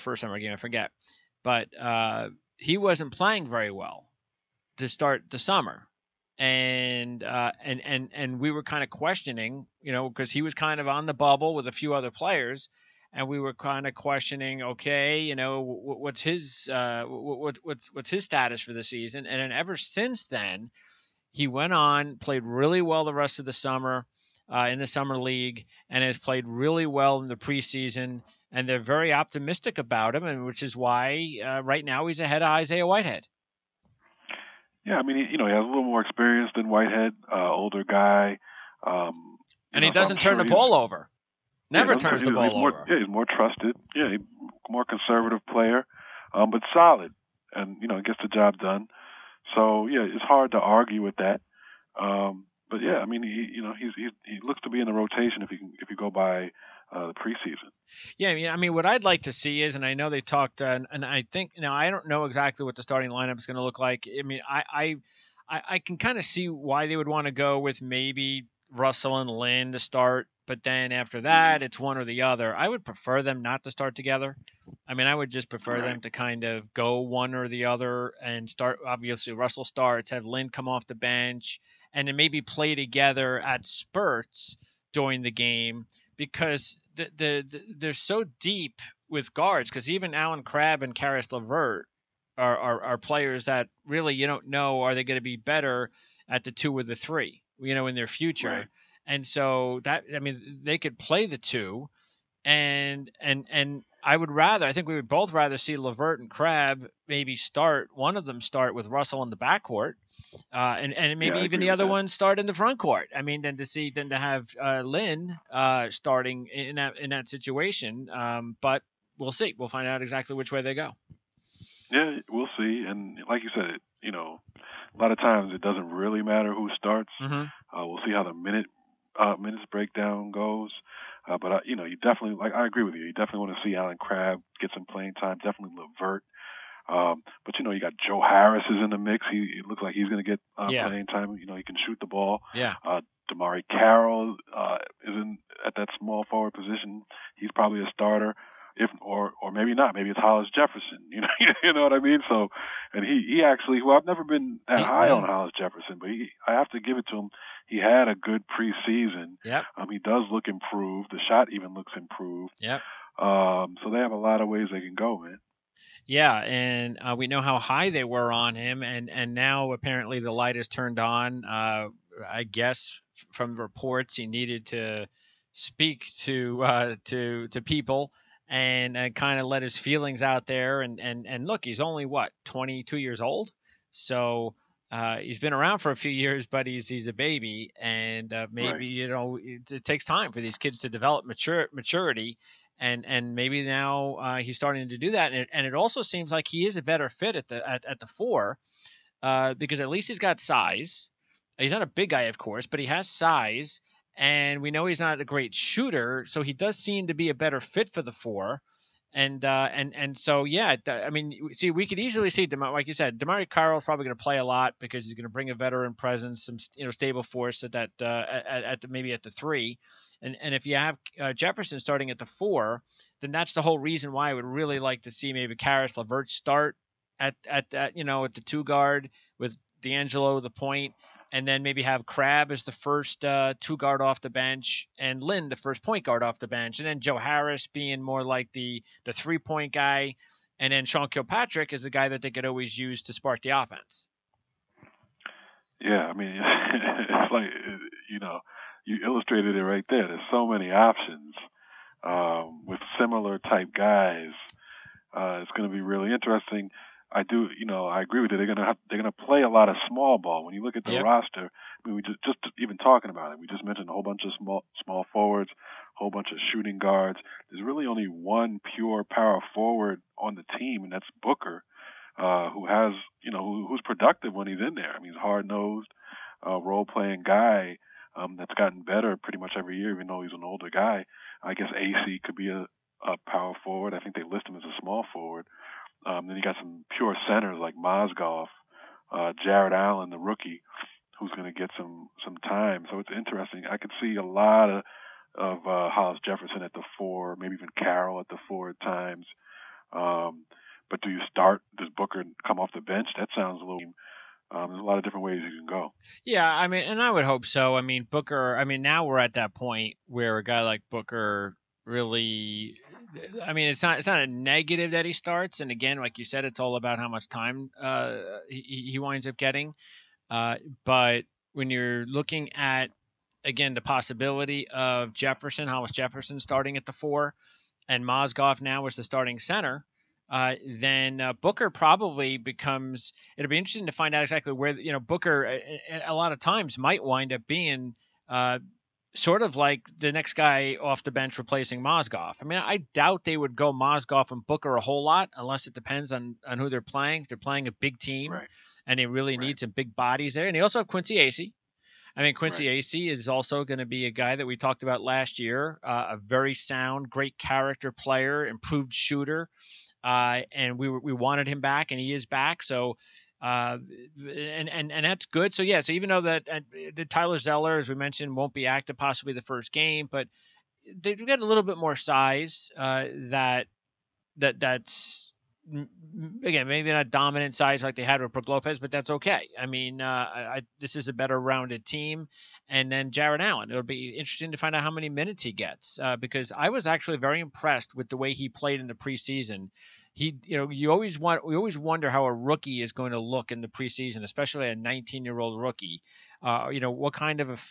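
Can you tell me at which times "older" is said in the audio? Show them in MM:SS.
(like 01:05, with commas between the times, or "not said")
00:37, 04:40.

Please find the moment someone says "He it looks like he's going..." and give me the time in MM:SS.
02:19.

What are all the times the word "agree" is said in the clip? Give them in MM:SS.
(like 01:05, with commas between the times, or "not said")
02:12, 04:18.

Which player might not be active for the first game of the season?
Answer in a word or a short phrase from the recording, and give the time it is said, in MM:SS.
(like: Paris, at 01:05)
Tyler Zeller, at 06:07.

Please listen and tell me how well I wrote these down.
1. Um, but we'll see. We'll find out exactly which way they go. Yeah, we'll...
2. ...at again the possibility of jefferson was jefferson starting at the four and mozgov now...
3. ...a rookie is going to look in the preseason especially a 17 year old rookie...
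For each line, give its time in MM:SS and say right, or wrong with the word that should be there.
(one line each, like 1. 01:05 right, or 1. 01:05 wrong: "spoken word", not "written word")
1. 01:58 right
2. 05:22 right
3. 06:32 wrong: "19", not "17".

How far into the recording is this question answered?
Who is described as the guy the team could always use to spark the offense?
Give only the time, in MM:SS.
04:00.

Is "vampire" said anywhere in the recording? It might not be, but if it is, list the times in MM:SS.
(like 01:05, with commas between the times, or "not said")
not said.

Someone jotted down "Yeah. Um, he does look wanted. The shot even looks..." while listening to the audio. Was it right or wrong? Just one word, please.
wrong.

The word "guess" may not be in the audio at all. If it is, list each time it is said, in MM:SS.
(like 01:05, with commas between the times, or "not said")
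02:52, 04:41.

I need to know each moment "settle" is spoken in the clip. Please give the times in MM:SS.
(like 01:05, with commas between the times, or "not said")
not said.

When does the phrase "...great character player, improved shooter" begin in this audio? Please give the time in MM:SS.
05:57.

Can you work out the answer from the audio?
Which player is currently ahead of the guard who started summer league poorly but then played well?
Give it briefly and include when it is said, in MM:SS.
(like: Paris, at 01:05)
Isaiah Whitehead, at 00:32.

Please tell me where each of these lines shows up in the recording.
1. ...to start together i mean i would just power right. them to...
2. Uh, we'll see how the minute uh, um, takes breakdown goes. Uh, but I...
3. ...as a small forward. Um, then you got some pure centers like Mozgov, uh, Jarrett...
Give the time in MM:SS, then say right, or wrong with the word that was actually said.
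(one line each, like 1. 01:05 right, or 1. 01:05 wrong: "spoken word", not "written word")
1. 01:13 wrong: "prefer", not "power"
2. 02:07 wrong: "minutes", not "takes"
3. 04:44 right.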